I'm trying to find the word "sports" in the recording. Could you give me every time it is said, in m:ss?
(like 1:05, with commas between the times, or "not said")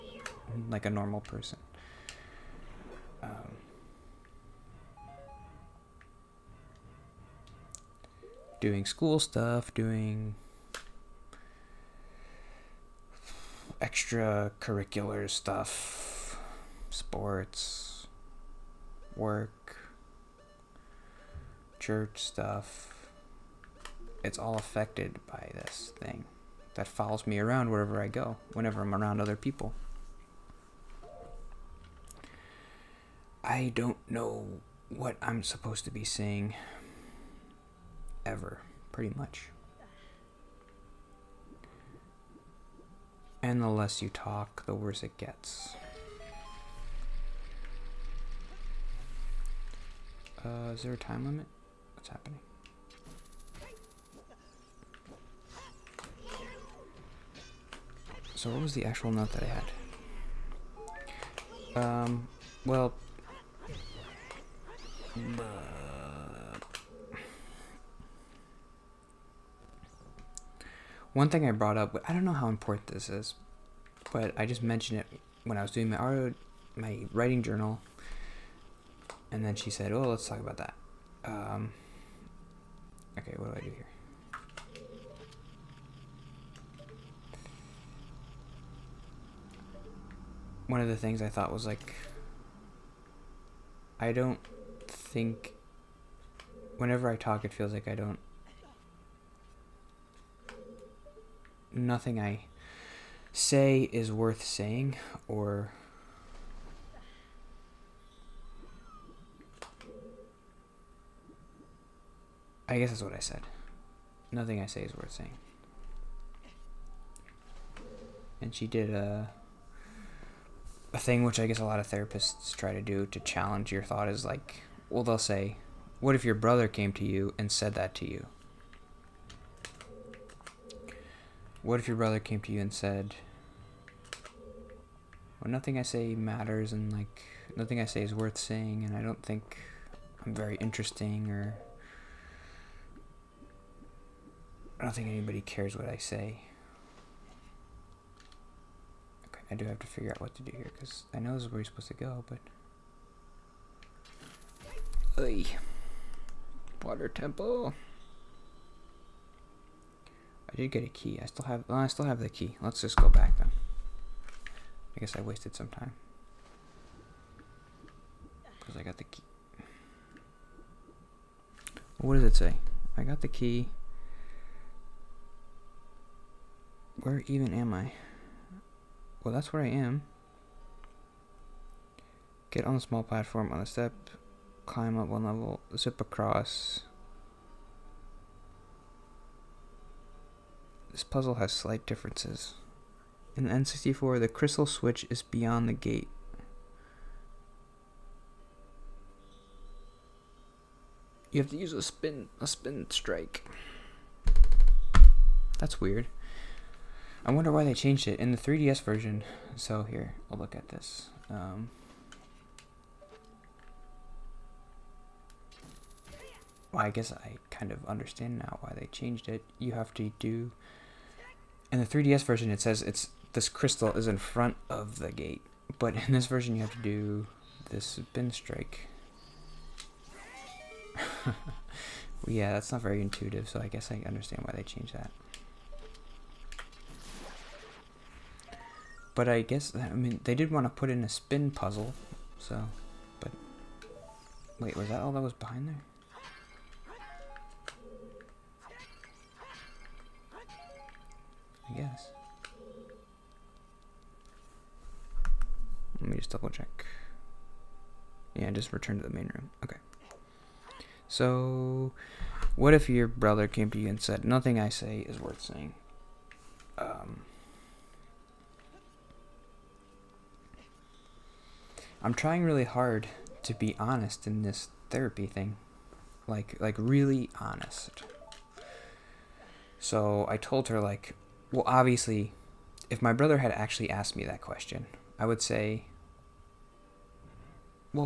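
0:16.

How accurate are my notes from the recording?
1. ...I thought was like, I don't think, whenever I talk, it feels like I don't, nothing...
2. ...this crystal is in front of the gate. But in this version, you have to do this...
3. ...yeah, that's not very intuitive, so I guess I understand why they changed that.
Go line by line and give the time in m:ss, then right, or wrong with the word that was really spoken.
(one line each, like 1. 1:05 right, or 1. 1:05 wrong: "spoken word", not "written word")
1. 1:31 right
2. 3:43 right
3. 3:52 right.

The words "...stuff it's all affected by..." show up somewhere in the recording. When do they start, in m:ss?
0:22.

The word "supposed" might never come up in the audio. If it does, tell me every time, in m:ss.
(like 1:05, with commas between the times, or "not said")
0:35, 2:31.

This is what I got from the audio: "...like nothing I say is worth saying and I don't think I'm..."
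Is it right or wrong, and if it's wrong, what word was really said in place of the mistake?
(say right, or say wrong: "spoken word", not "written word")
right.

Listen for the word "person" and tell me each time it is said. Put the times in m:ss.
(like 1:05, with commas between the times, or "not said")
0:01.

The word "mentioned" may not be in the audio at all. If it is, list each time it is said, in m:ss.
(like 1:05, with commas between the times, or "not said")
1:14.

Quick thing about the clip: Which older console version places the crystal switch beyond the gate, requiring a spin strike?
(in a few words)
N64.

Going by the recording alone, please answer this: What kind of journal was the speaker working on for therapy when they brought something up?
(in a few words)
writing journal.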